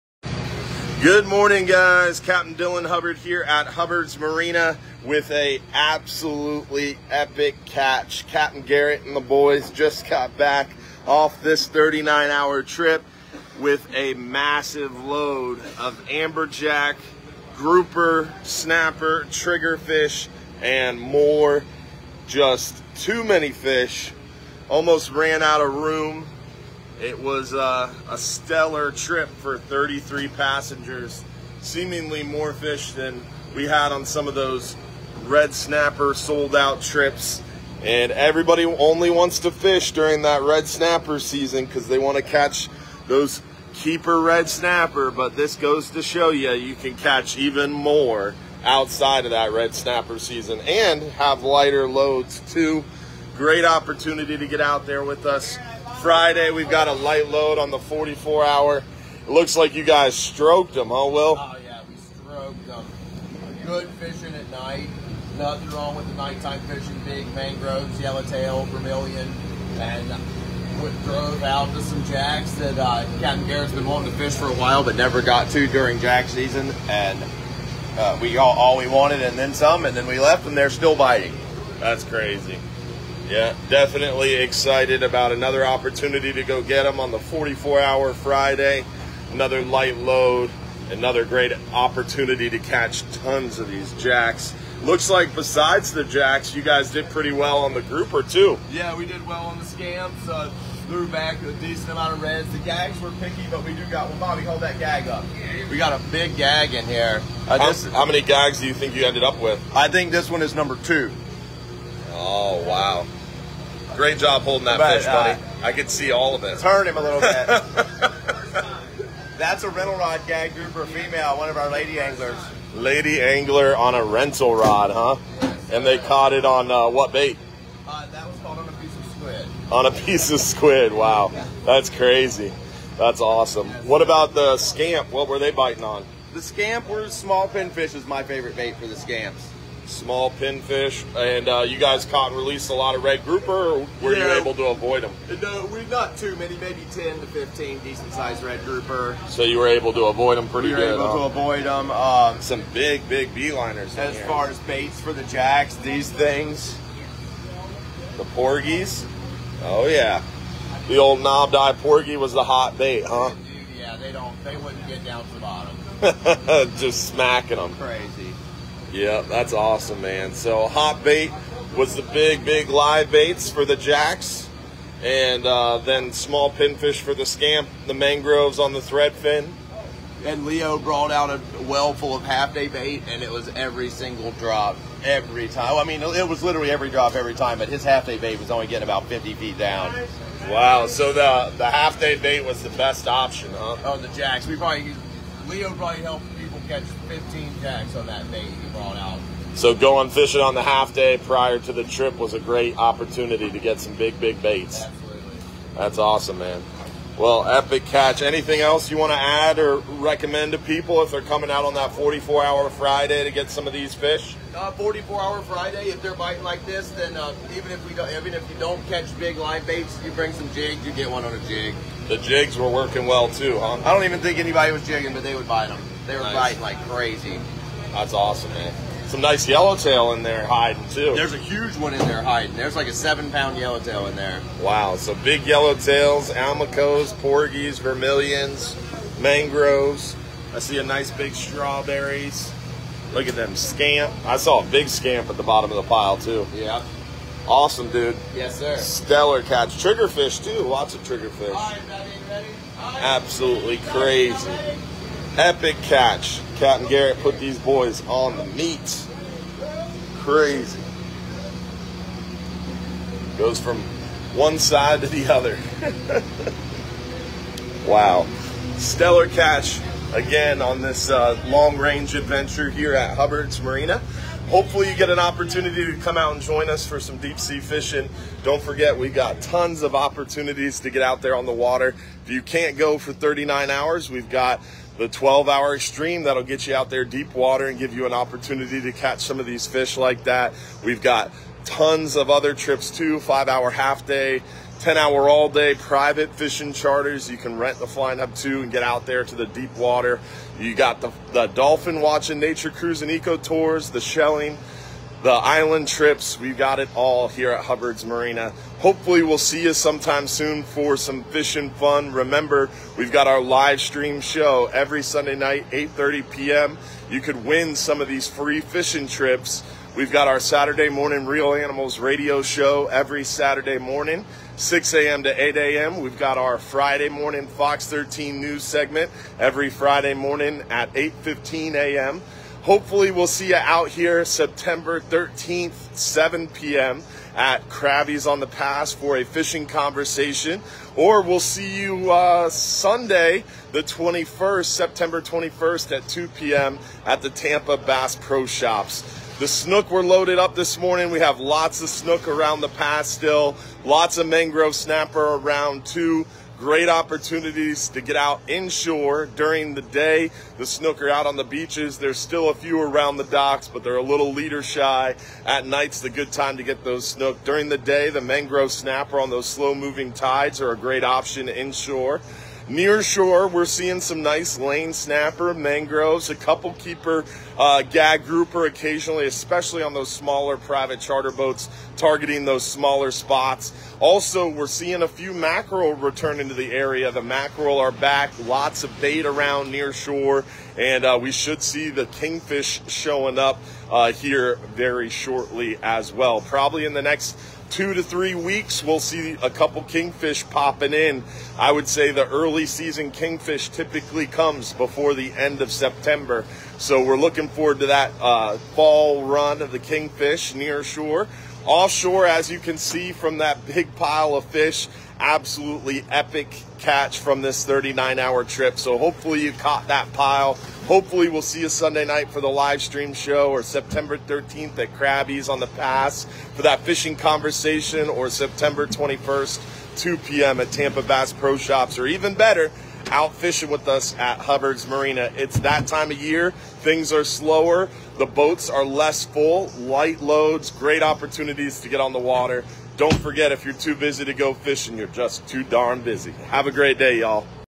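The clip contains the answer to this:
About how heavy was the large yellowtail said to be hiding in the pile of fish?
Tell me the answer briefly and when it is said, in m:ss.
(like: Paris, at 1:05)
7 pounds, at 3:52.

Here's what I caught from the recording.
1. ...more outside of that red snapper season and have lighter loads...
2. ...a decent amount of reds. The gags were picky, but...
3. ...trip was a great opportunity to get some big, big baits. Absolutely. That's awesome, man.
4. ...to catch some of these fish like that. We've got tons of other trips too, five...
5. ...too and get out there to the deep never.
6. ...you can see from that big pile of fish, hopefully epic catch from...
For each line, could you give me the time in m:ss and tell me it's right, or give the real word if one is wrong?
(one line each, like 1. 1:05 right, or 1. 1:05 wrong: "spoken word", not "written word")
1. 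0:47 right
2. 1:41 right
3. 3:21 right
4. 4:48 right
5. 4:58 wrong: "water", not "never"
6. 6:52 wrong: "absolutely", not "hopefully".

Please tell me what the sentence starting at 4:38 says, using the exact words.
Don't forget, we got tons of opportunities to get out there on the water.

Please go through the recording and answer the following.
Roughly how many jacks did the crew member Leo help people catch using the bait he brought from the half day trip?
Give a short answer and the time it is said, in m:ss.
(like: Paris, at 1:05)
15, at 3:17.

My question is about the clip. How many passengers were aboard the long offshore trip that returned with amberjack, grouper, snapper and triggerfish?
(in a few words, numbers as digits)
33.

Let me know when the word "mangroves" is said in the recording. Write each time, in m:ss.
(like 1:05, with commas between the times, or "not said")
1:07, 2:57, 3:59, 5:54, 6:08, 6:15.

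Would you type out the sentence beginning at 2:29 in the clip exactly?
So you were able to avoid them pretty good?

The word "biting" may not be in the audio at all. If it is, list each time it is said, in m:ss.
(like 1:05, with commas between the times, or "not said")
1:20, 2:15, 3:36, 3:46.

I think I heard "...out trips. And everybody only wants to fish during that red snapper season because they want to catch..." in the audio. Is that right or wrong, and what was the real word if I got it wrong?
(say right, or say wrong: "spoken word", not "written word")
right.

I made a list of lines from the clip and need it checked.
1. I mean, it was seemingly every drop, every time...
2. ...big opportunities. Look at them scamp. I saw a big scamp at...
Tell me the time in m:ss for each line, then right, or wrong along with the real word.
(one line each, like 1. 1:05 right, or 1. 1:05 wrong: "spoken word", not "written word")
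1. 3:05 wrong: "literally", not "seemingly"
2. 4:01 wrong: "strawberries", not "opportunities".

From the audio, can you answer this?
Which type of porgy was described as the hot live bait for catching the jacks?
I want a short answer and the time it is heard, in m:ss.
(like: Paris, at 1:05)
knobbed eye porgy, at 2:41.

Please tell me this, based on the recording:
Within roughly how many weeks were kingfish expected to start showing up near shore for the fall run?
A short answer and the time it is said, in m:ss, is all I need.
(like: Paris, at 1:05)
2 to 3 weeks, at 6:37.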